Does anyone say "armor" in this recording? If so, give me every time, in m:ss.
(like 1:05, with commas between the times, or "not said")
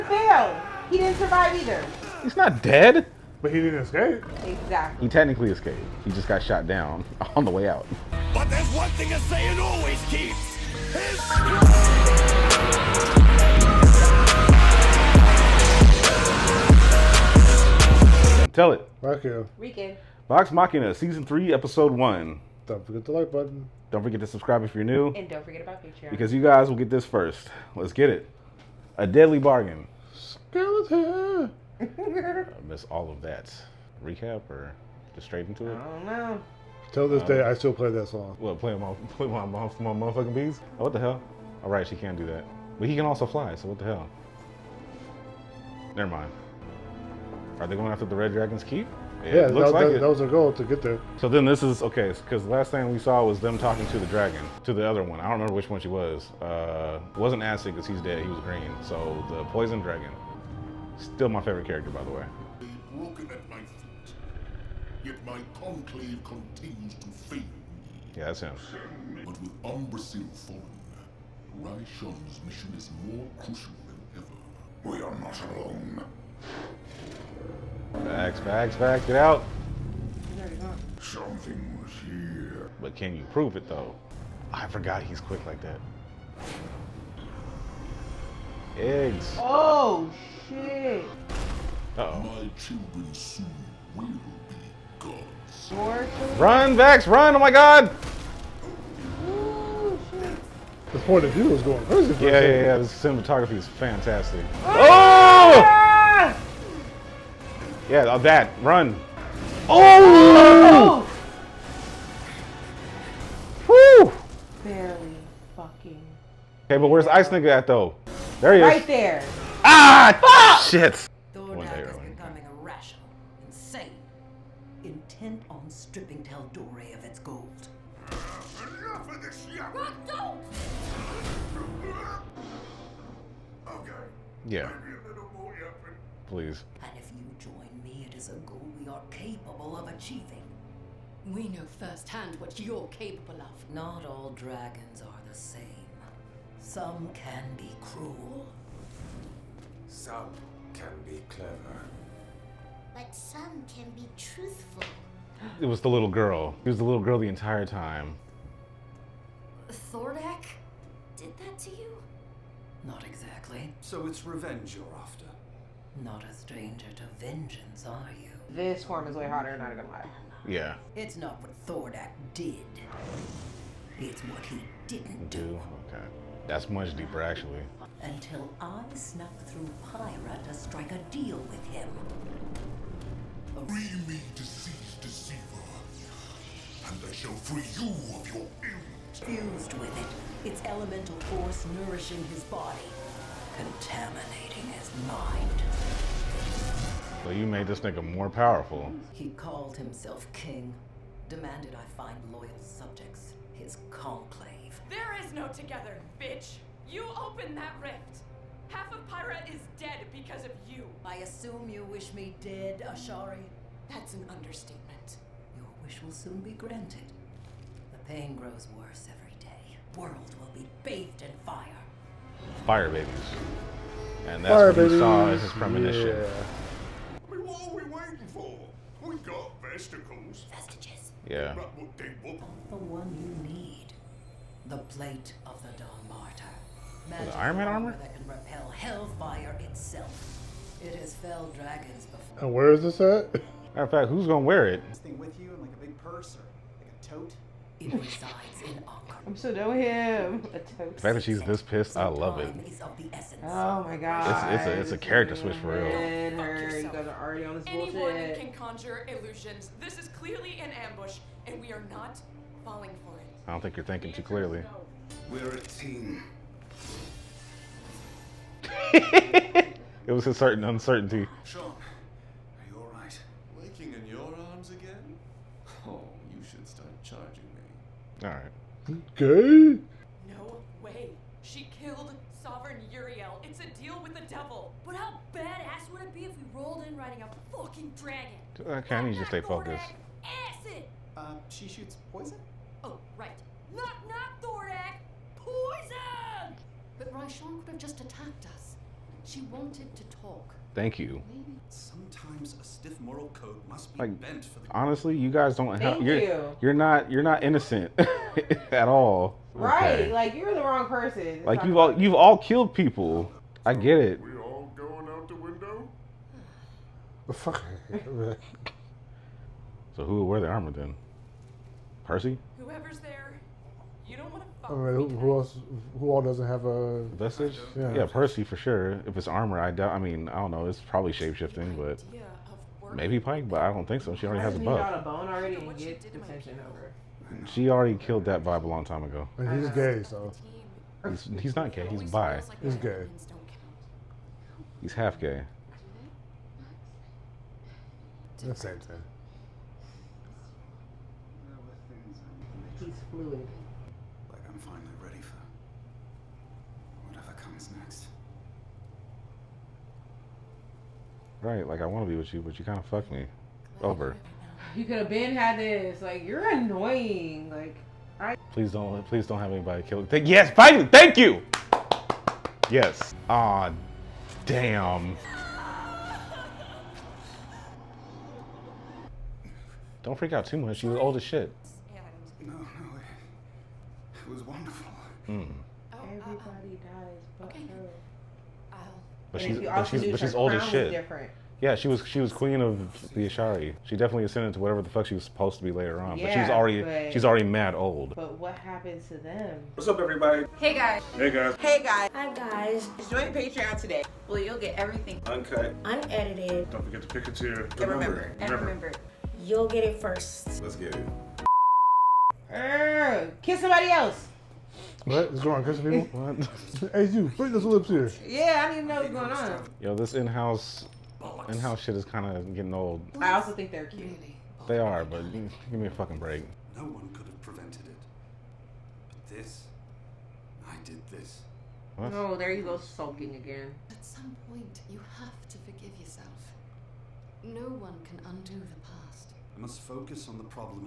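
3:57, 5:20, 5:29.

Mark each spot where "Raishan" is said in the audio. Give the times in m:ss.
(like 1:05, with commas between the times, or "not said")
1:11, 4:57.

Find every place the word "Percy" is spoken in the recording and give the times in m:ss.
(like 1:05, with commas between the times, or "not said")
5:22, 5:28.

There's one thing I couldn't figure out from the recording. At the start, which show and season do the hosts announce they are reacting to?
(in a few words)
Vox Machina, Season 3.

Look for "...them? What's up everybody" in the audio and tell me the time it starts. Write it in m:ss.
6:39.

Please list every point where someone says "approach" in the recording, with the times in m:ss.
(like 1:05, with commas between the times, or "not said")
not said.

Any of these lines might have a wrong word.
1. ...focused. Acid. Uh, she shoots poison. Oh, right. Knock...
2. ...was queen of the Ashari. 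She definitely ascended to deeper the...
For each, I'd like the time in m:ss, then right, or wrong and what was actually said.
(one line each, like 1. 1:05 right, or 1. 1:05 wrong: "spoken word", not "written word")
1. 4:49 right
2. 6:32 wrong: "whatever", not "deeper".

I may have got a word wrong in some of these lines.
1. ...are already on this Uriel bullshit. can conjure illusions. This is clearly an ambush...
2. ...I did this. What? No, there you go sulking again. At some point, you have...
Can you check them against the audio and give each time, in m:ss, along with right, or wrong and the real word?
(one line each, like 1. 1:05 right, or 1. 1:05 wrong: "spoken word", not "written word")
1. 4:17 wrong: "Anyone", not "Uriel"
2. 7:10 right.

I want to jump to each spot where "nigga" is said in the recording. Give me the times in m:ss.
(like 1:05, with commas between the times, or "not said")
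1:57, 3:17.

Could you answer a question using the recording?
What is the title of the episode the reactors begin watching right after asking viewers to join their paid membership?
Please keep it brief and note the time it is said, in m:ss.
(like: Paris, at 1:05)
A Deadly Bargain, at 0:28.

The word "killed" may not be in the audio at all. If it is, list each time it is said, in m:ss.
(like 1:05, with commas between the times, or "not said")
4:41, 5:12, 5:37, 6:09.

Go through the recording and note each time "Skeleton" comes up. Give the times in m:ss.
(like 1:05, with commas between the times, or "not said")
0:30.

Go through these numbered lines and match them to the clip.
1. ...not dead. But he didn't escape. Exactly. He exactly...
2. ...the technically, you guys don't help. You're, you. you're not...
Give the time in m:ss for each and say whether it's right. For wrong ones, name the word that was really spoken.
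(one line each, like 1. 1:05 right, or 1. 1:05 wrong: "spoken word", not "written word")
1. 0:02 wrong: "technically", not "exactly"
2. 5:04 wrong: "honestly", not "technically".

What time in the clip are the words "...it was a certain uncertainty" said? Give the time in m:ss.
4:28.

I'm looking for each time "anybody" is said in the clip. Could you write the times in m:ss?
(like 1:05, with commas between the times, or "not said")
6:09.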